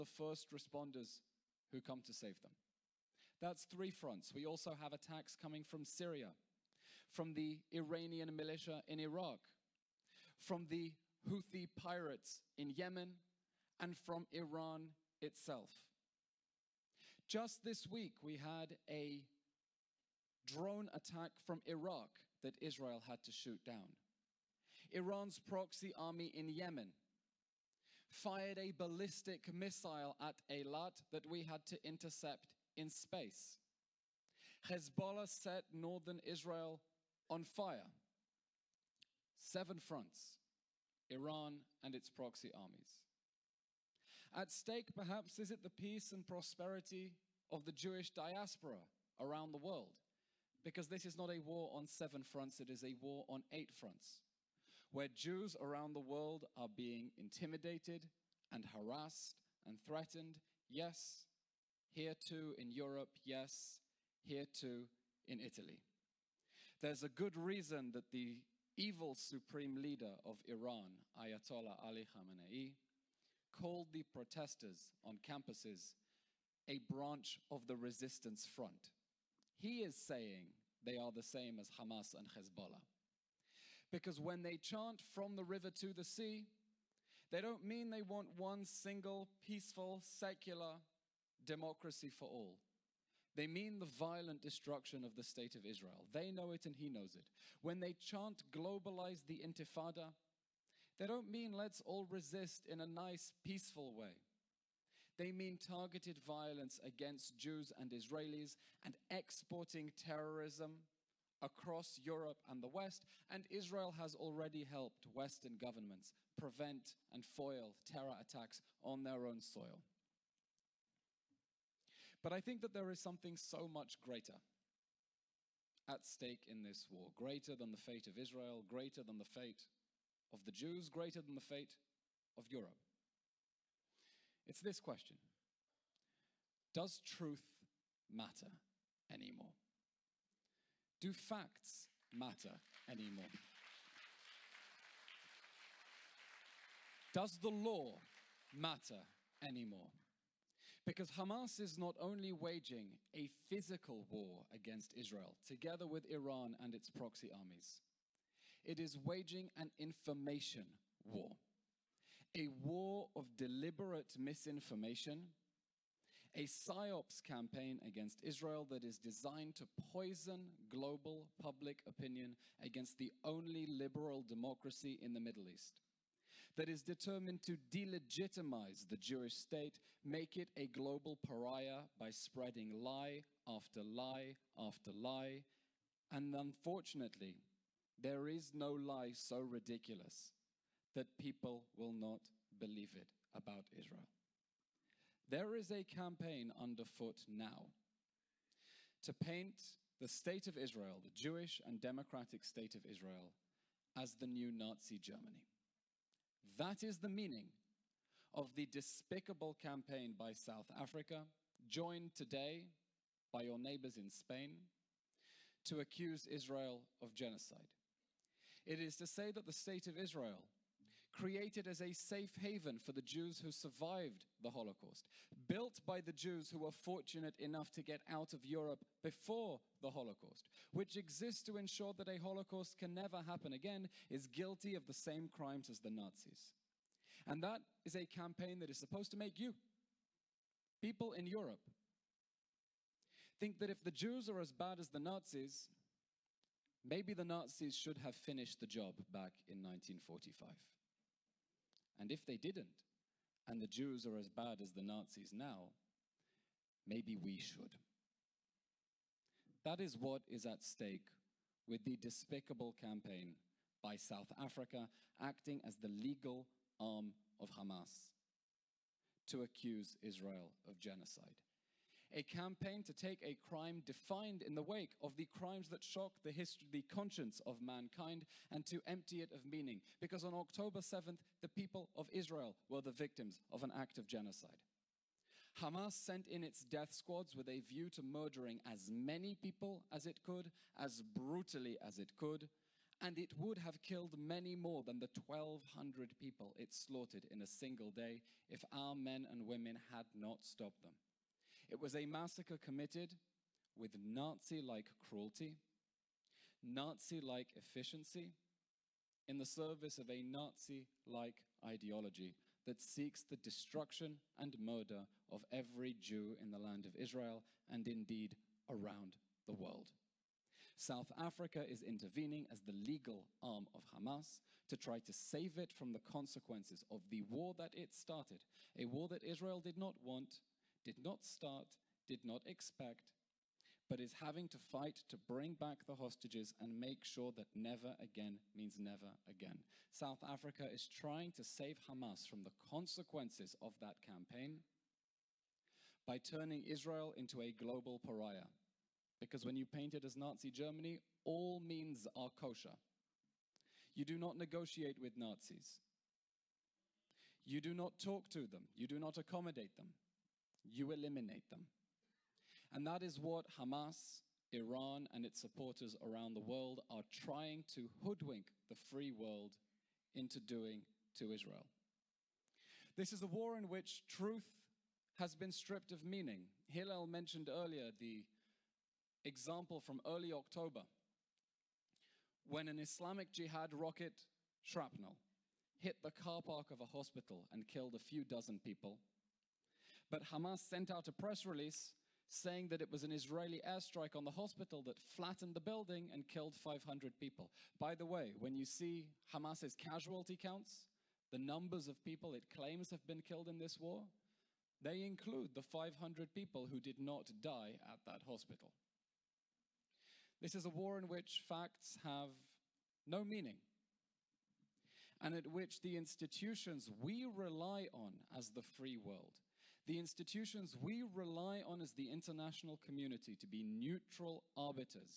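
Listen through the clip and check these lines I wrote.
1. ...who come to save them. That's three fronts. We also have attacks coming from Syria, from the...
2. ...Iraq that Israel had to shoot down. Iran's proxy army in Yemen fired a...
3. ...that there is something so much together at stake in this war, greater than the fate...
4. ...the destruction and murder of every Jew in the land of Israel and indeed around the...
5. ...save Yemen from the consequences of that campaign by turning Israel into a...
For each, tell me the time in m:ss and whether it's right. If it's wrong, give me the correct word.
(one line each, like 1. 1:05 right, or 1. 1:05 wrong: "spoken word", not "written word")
1. 0:01 right
2. 0:21 right
3. 2:02 wrong: "greater", not "together"
4. 5:13 right
5. 5:41 wrong: "Hamas", not "Yemen".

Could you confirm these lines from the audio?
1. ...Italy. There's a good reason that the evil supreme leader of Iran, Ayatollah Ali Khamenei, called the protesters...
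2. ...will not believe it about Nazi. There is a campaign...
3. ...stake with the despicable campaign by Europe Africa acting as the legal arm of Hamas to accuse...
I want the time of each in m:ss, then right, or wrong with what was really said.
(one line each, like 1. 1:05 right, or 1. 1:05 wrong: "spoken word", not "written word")
1. 1:05 right
2. 3:11 wrong: "Israel", not "Nazi"
3. 4:20 wrong: "South", not "Europe".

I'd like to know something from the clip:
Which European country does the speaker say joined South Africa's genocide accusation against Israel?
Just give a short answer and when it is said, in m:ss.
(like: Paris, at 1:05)
Spain, at 3:34.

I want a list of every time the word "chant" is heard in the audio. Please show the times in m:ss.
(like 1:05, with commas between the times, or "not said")
1:24, 1:37.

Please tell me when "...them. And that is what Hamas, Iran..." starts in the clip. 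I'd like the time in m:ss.
6:01.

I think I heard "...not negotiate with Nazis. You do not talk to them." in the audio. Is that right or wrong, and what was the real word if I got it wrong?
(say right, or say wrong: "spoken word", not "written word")
right.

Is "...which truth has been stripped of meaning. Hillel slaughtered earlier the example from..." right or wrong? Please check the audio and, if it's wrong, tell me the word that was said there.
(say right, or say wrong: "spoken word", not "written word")
wrong: "mentioned", not "slaughtered".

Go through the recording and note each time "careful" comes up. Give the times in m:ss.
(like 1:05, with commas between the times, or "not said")
not said.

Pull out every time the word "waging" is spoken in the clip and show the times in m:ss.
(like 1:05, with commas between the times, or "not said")
2:32, 2:38.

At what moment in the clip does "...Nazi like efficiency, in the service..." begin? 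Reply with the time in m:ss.
5:06.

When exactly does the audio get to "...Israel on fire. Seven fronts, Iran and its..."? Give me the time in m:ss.
0:36.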